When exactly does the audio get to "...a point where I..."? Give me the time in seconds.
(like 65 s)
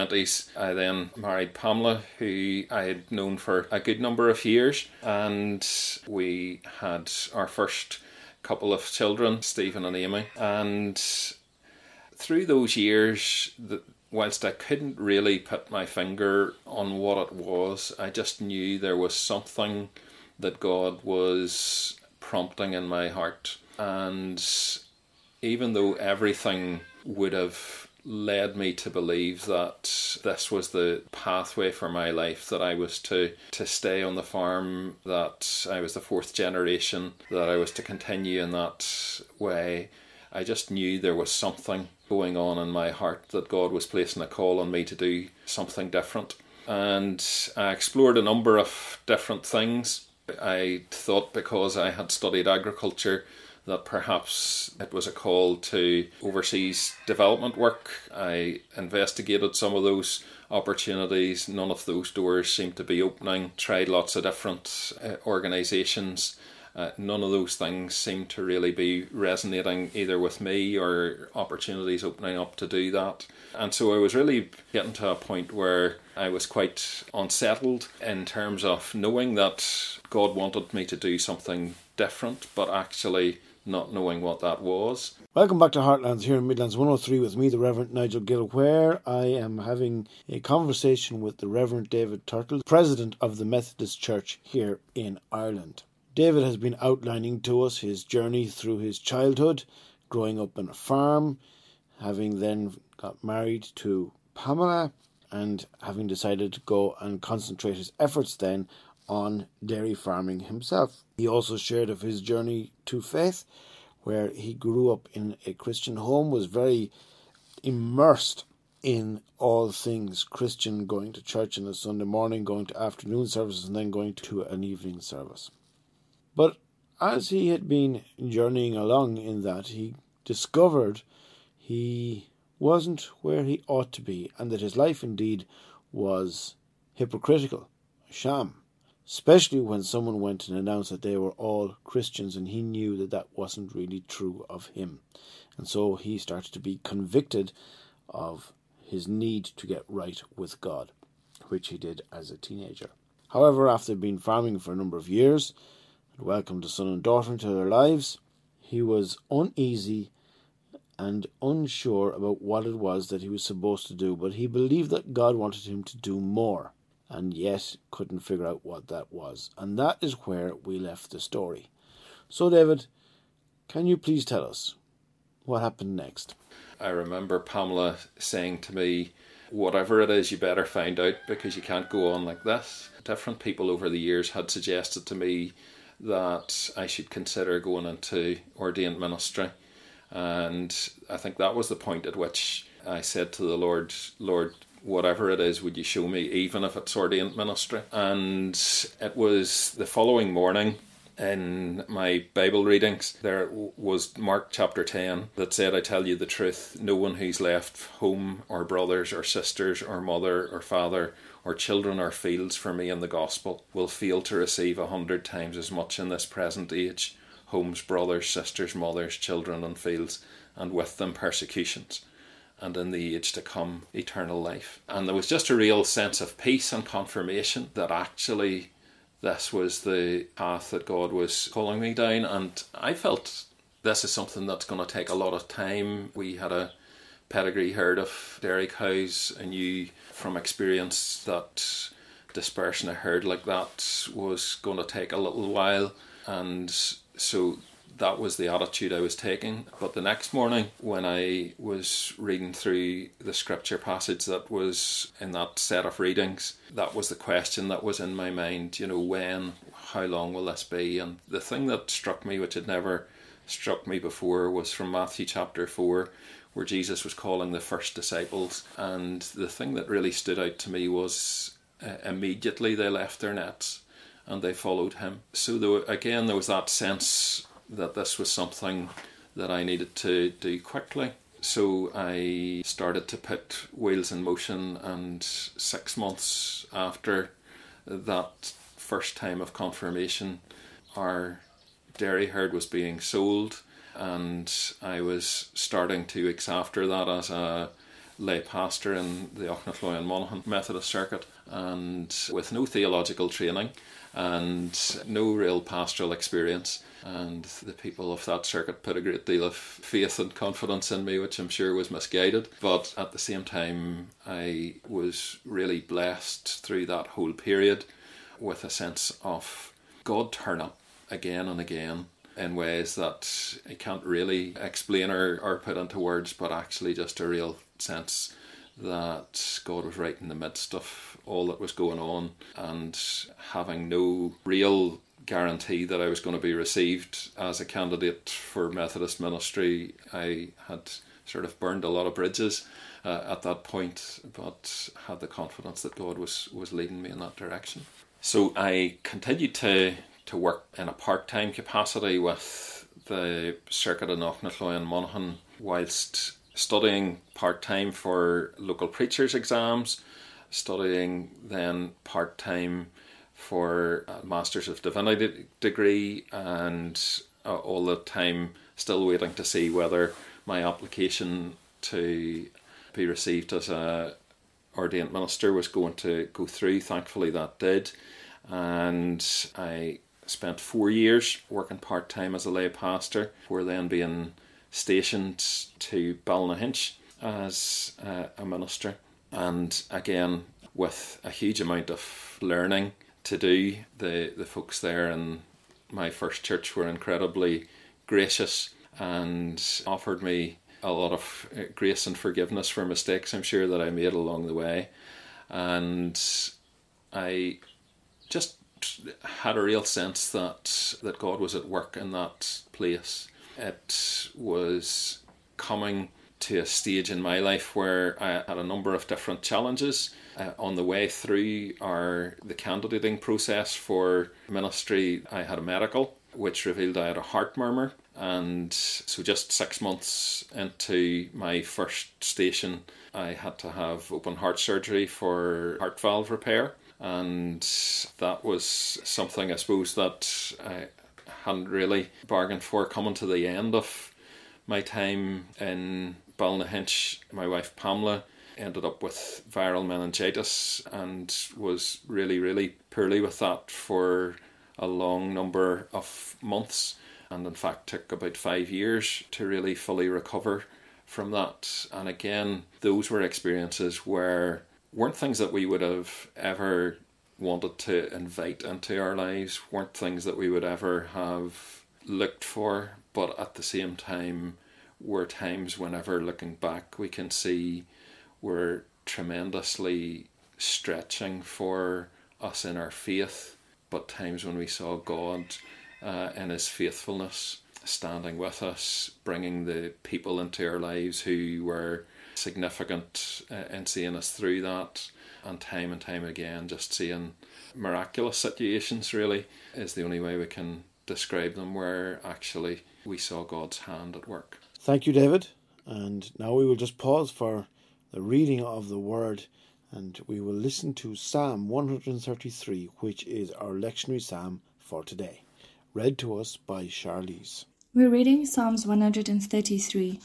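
75 s.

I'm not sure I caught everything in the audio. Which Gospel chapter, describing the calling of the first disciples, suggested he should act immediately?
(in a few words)
Matthew 4.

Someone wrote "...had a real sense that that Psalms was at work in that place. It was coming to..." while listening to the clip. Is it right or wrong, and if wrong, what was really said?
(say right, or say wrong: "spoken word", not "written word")
wrong: "God", not "Psalms".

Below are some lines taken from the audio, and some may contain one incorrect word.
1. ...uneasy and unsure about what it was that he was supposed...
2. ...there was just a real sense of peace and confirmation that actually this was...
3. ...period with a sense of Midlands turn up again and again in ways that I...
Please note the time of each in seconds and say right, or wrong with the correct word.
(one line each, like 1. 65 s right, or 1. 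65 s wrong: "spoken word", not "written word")
1. 159 s right
2. 225 s right
3. 317 s wrong: "God", not "Midlands".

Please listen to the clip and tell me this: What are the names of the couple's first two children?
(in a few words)
Stephen and Amy.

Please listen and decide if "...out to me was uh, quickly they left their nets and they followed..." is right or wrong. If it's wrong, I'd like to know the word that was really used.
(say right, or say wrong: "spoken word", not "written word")
wrong: "immediately", not "quickly".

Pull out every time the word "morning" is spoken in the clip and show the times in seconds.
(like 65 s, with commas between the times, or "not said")
122 s, 200 s, 250 s.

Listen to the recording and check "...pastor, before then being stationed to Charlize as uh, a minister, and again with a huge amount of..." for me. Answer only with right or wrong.
wrong.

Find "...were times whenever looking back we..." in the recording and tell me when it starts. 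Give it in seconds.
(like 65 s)
475 s.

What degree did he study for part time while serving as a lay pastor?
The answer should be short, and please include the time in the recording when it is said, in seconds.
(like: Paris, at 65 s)
Masters of Divinity, at 364 s.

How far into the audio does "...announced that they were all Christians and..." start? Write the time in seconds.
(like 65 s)
140 s.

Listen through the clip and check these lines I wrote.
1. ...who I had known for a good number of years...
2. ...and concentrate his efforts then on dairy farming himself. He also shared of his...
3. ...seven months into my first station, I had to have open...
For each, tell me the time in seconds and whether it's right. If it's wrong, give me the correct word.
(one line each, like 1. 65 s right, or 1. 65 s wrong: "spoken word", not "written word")
1. 2 s right
2. 106 s right
3. 429 s wrong: "six", not "seven".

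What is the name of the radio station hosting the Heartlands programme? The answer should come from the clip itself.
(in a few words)
Midlands 103.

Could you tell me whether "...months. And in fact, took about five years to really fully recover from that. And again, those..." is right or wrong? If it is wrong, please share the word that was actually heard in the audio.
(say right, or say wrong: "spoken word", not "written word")
right.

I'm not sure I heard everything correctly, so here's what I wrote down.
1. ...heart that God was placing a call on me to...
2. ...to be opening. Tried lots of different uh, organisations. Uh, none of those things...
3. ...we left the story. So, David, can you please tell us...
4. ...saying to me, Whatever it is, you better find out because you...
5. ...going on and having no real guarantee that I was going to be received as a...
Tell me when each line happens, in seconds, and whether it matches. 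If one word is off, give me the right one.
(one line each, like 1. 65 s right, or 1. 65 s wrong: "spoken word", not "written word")
1. 42 s right
2. 62 s right
3. 170 s right
4. 178 s right
5. 331 s right.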